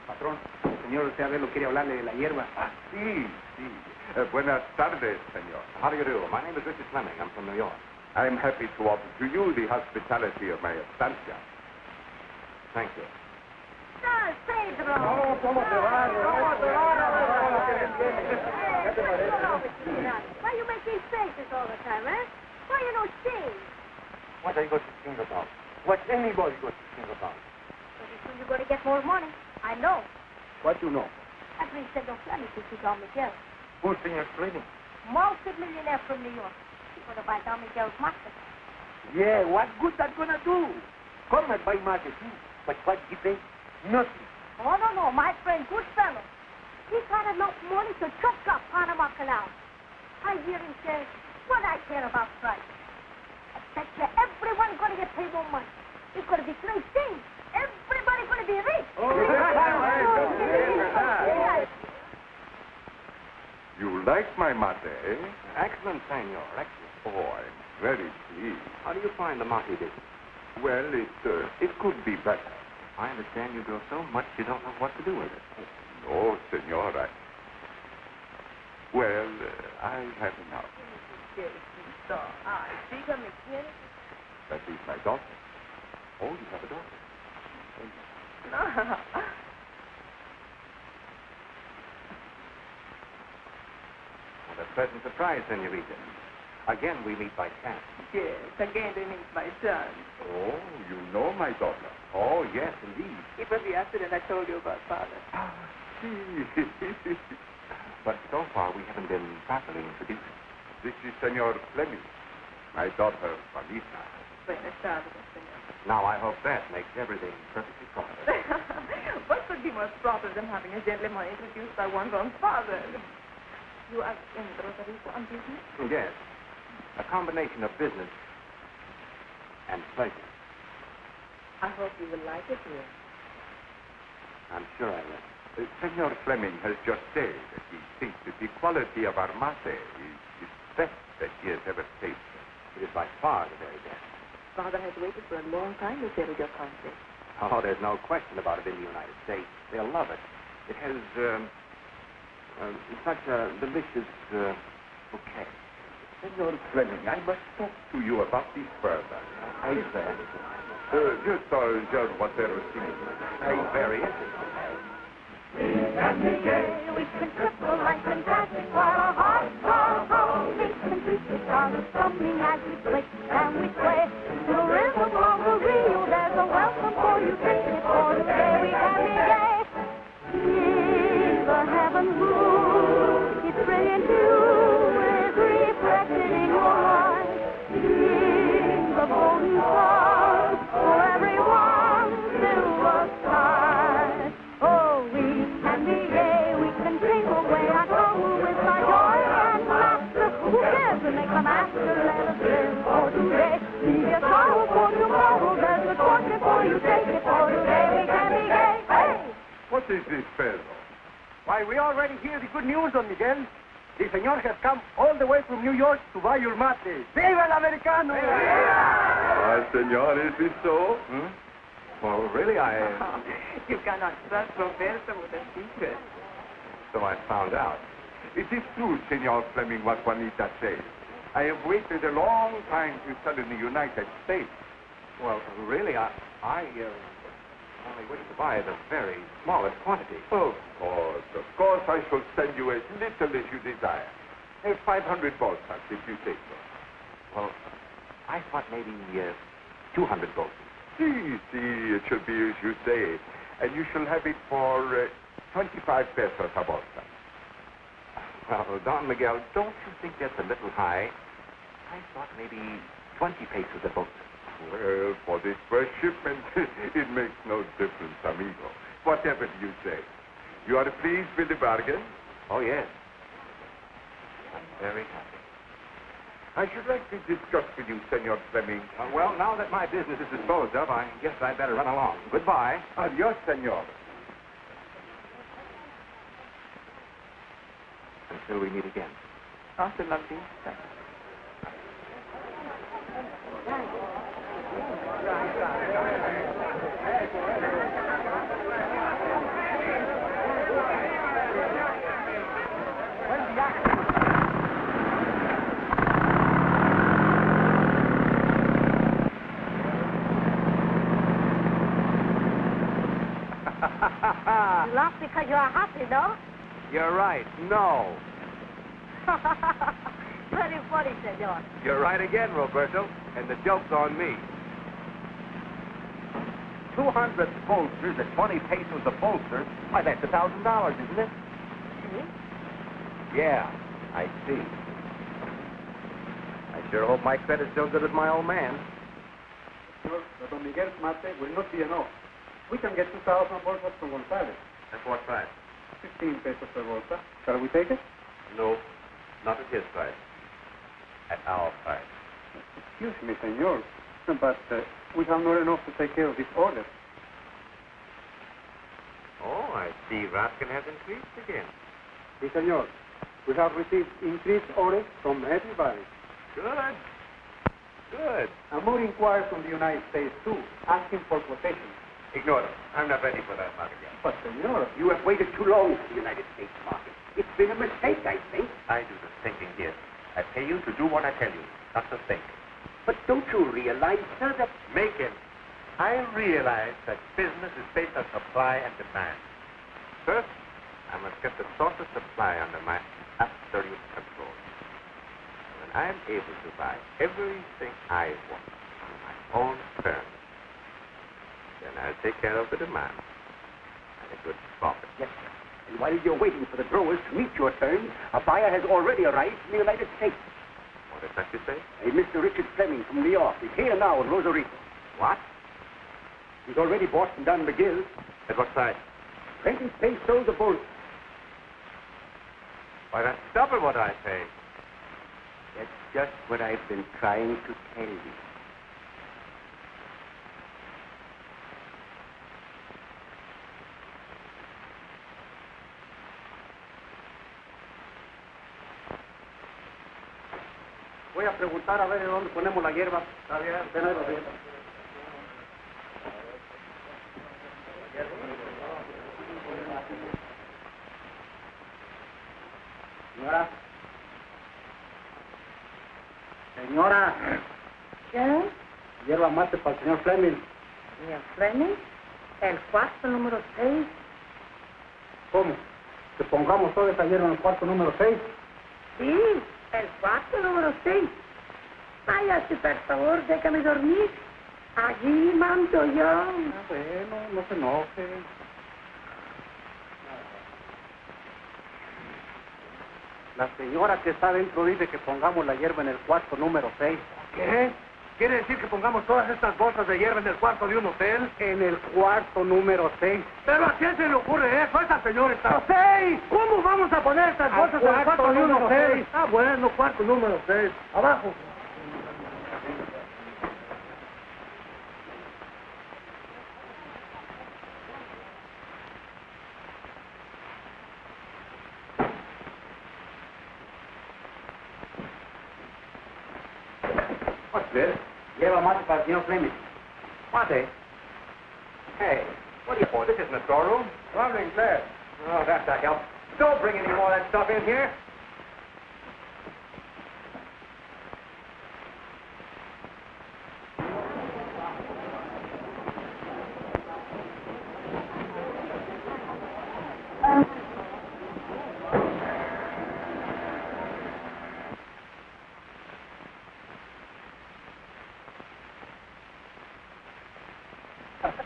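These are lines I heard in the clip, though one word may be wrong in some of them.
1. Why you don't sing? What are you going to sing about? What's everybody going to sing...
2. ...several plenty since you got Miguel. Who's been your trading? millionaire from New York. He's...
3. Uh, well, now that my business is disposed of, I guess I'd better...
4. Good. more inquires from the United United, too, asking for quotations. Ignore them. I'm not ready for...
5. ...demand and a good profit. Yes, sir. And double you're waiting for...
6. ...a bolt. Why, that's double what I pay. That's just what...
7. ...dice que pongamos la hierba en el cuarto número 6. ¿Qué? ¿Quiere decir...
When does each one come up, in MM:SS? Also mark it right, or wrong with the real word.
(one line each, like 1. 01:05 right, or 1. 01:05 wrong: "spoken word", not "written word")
1. 00:22 wrong: "anybody", not "everybody"
2. 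00:31 right
3. 04:38 right
4. 06:08 wrong: "States", not "United"
5. 06:42 wrong: "while", not "double"
6. 07:00 right
7. 08:04 right.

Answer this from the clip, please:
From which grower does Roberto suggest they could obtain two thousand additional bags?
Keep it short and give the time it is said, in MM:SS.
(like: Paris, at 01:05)
Gonzalez, at 05:44.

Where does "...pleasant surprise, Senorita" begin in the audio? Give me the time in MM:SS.
01:34.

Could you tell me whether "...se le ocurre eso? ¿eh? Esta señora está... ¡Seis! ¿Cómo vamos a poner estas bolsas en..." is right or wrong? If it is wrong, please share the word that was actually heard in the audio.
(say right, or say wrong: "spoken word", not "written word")
right.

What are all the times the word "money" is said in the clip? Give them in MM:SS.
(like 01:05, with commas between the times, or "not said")
00:29, 00:47, 00:55.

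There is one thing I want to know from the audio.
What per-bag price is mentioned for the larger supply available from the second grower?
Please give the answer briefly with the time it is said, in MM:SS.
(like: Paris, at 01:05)
15 pesos, at 05:46.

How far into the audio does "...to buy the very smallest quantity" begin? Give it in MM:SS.
03:58.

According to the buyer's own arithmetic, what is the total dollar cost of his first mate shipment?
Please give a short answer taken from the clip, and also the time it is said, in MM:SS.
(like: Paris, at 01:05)
$1,000, at 05:30.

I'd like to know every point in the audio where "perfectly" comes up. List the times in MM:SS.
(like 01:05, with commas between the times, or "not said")
01:57.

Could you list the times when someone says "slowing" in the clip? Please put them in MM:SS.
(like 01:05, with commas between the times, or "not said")
not said.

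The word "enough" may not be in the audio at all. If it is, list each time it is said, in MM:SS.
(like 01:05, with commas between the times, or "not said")
00:47, 01:20, 05:41, 05:55.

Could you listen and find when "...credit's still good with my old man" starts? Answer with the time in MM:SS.
05:37.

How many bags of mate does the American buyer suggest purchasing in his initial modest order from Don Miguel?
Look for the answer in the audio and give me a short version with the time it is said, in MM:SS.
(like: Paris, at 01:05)
200, at 04:09.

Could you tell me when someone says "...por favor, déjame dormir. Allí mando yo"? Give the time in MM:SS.
07:52.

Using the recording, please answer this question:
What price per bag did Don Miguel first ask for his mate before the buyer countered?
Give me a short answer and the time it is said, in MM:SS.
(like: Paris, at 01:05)
25 pesos, at 04:15.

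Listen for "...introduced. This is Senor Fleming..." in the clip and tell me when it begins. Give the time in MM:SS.
01:49.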